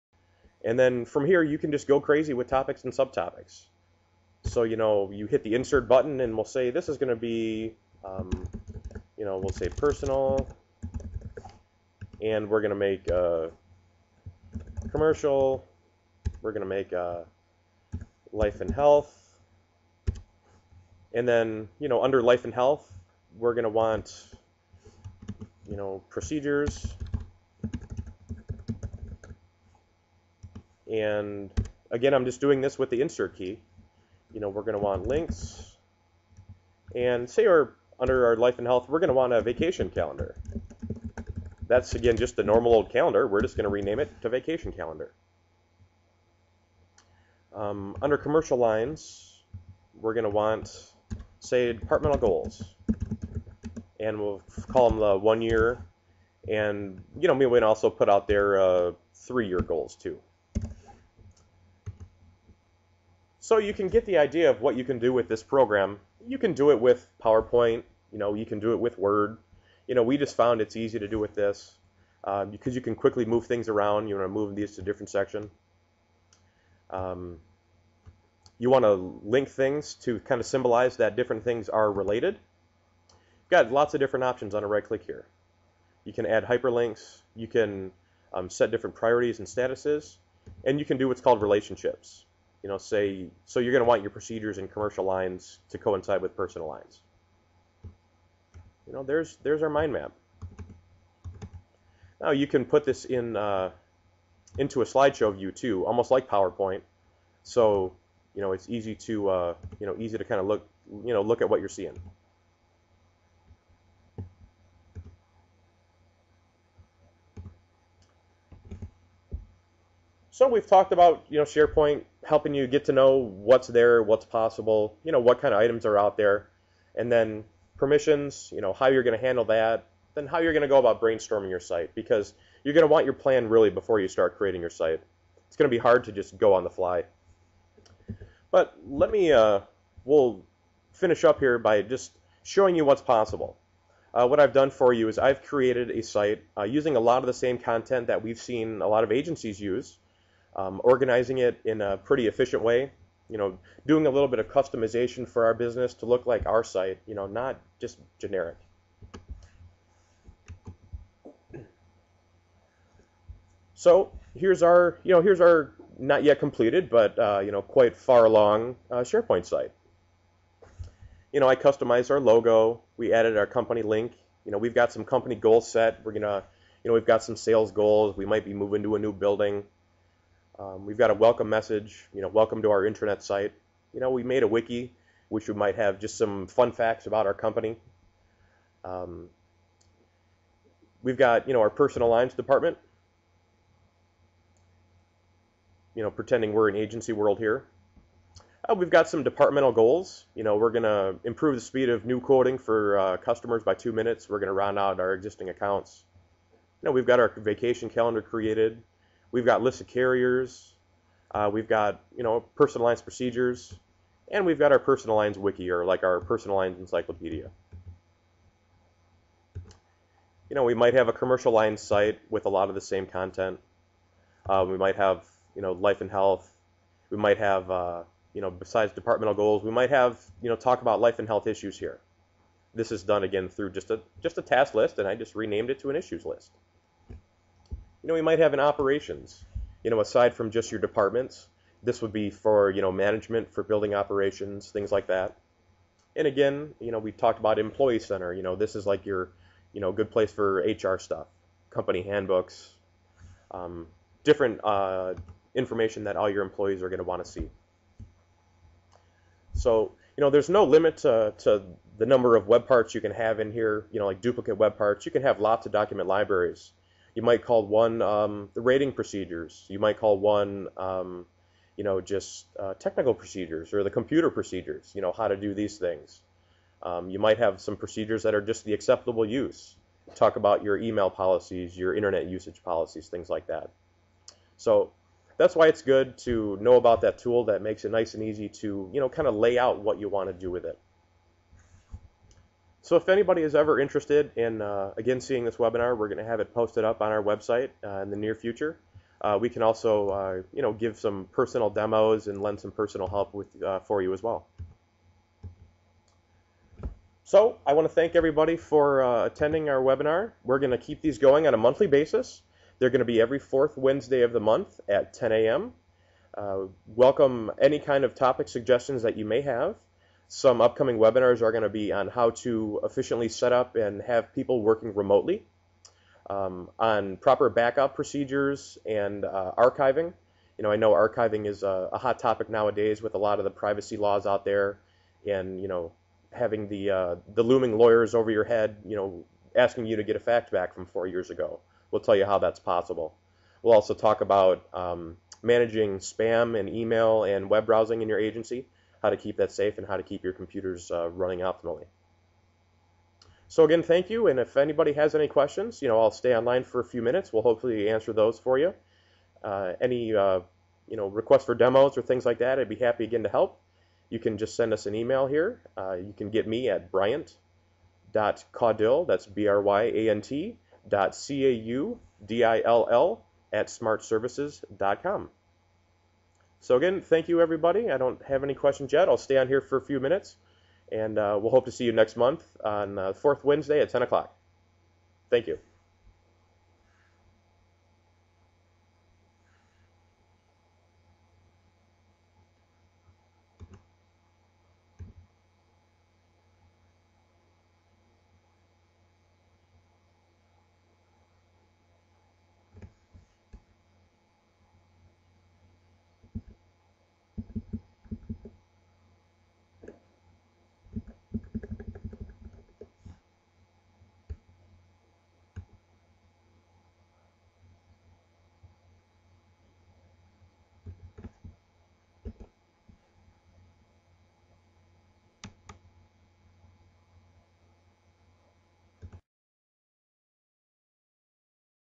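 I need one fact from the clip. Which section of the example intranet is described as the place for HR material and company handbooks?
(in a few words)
Employee center.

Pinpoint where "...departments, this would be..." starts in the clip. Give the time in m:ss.
4:00.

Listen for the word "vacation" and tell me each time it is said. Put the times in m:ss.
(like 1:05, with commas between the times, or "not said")
0:39, 0:44, 3:27.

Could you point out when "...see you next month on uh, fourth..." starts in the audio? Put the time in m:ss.
6:21.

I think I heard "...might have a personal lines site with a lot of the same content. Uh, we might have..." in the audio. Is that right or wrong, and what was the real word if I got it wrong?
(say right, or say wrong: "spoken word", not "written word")
wrong: "commercial", not "personal".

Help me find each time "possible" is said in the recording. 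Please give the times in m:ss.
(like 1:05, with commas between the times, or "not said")
2:04, 2:23, 5:42.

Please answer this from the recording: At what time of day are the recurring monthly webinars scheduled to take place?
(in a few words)
10 a.m.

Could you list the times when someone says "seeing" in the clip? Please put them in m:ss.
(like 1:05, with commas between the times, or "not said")
1:51, 4:55.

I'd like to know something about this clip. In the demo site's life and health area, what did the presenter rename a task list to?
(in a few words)
Issues list.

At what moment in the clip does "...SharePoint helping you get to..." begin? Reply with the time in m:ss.
2:01.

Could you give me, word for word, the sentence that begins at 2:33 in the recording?
You know, doing a little bit of customization for our business to look like our site.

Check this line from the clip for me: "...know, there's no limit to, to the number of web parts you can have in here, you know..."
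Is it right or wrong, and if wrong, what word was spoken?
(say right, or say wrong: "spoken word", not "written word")
right.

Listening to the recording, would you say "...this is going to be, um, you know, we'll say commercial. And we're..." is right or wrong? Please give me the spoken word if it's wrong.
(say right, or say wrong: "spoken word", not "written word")
wrong: "personal", not "commercial".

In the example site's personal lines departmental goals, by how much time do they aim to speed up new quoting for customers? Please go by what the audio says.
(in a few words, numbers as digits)
2 minutes.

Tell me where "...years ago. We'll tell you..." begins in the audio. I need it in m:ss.
5:41.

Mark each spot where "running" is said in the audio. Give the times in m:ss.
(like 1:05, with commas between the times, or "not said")
5:51.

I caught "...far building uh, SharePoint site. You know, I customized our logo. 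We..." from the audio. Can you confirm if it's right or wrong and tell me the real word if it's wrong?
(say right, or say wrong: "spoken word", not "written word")
wrong: "along", not "building".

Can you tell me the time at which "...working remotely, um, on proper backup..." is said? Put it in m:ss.
5:24.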